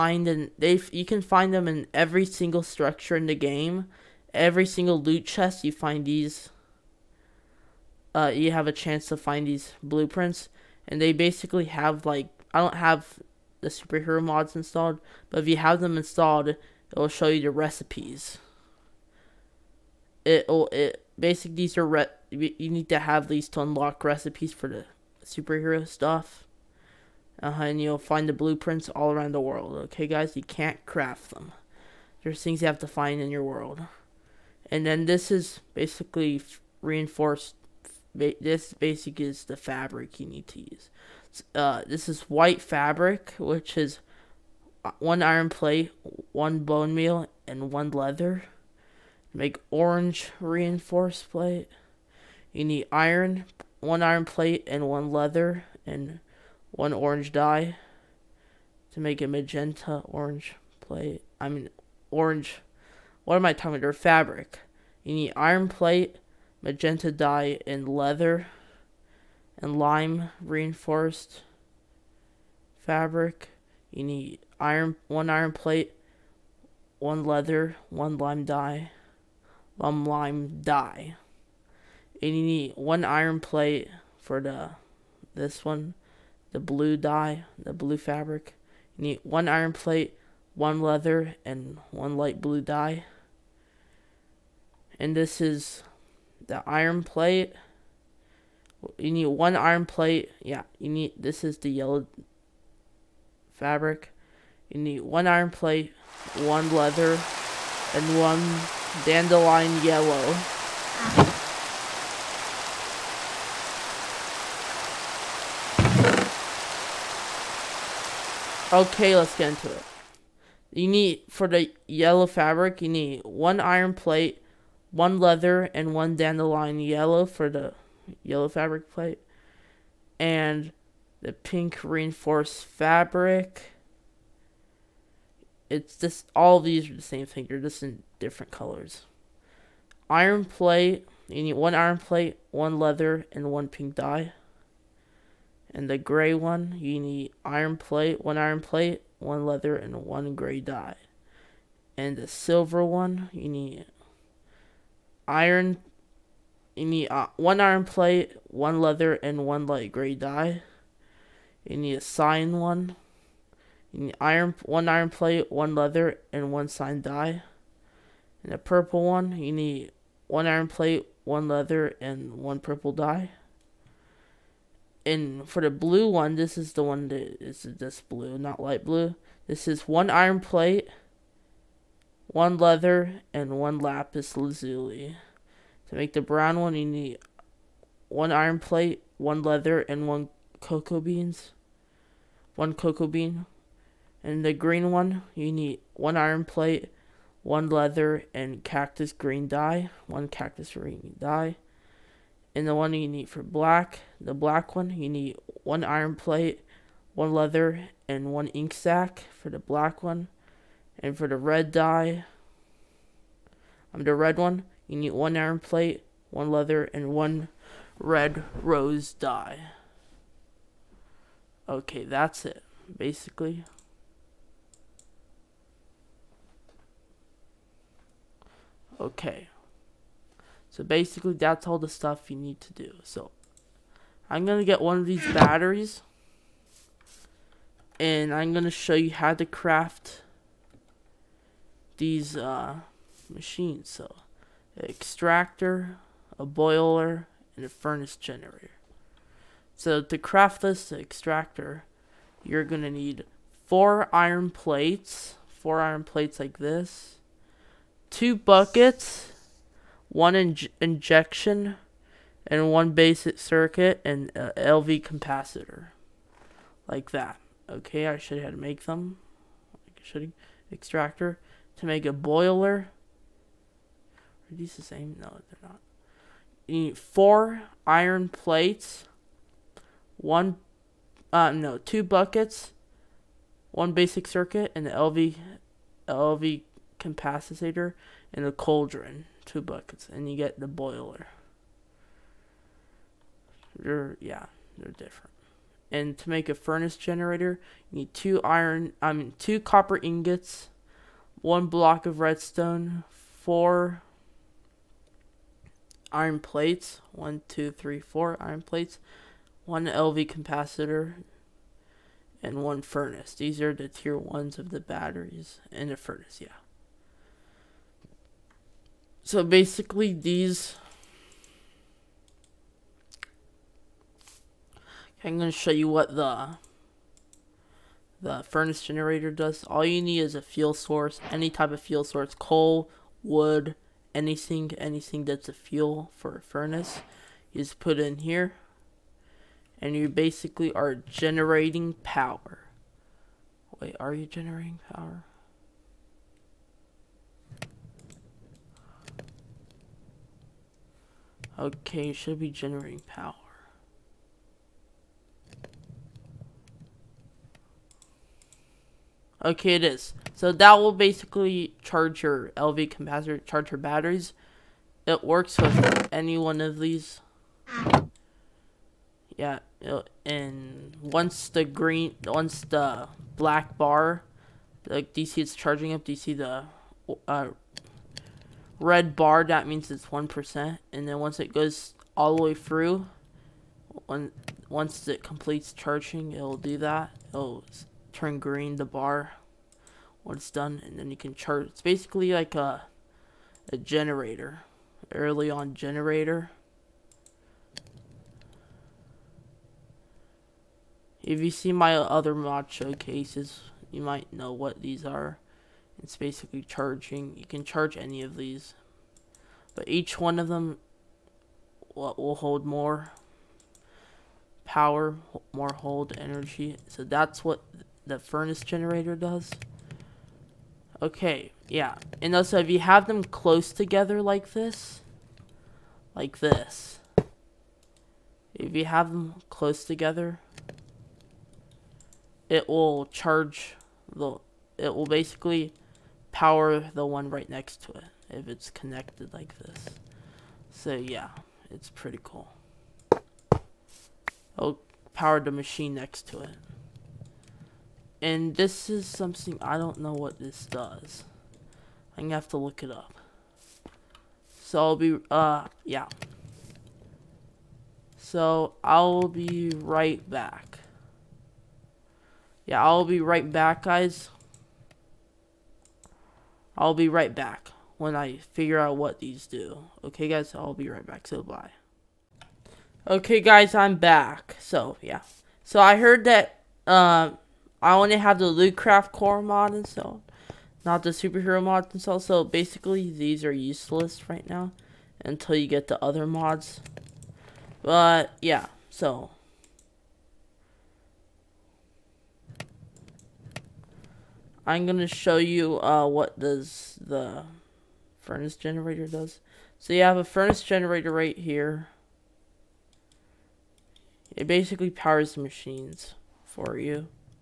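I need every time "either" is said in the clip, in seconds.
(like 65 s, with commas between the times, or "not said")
not said.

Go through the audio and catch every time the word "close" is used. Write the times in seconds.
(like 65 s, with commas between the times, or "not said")
423 s, 429 s.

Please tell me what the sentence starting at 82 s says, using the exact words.
And you need one iron plate for the this one, the blue dye, the blue fabric.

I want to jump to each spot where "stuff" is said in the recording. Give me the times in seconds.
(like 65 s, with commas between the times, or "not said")
25 s, 231 s.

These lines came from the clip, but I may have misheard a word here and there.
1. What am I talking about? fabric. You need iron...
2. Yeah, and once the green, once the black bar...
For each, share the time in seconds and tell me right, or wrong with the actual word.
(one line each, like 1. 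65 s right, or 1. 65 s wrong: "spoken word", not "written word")
1. 63 s right
2. 369 s right.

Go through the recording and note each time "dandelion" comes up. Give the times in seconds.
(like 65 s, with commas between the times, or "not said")
109 s, 126 s.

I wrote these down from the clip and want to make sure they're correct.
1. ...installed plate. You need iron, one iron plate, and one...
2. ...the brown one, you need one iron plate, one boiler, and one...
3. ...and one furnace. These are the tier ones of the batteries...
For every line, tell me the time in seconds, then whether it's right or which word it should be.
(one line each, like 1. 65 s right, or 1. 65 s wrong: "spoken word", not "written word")
1. 50 s wrong: "reinforced", not "installed"
2. 186 s wrong: "leather", not "boiler"
3. 312 s right.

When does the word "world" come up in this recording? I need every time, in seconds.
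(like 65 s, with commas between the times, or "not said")
29 s, 33 s.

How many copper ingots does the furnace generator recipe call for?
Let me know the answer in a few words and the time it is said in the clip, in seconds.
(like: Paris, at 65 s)
2, at 299 s.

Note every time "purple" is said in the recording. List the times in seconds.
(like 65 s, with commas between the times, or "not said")
168 s, 172 s.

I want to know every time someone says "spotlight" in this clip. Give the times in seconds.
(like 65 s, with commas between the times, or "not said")
not said.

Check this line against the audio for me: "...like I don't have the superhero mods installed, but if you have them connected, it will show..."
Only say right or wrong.
wrong.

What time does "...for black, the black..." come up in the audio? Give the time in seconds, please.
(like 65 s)
203 s.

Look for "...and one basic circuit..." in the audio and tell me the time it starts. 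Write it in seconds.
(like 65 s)
262 s.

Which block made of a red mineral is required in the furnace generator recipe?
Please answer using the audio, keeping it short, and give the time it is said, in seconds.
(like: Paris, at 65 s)
Block of redstone, at 301 s.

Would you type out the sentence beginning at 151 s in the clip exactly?
And the silver one, you need iron you need uh, one iron plate, one leather, and one light gray dye.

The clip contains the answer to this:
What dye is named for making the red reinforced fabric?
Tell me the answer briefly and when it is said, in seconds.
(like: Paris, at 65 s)
Red rose dye, at 217 s.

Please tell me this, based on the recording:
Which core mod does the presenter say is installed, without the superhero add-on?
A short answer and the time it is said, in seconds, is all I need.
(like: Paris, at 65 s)
Lucraft core, at 478 s.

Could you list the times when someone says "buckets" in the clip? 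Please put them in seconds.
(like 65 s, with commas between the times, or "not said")
258 s, 282 s, 289 s.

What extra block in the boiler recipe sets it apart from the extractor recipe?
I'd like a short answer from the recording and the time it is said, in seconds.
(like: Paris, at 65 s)
Cauldron, at 288 s.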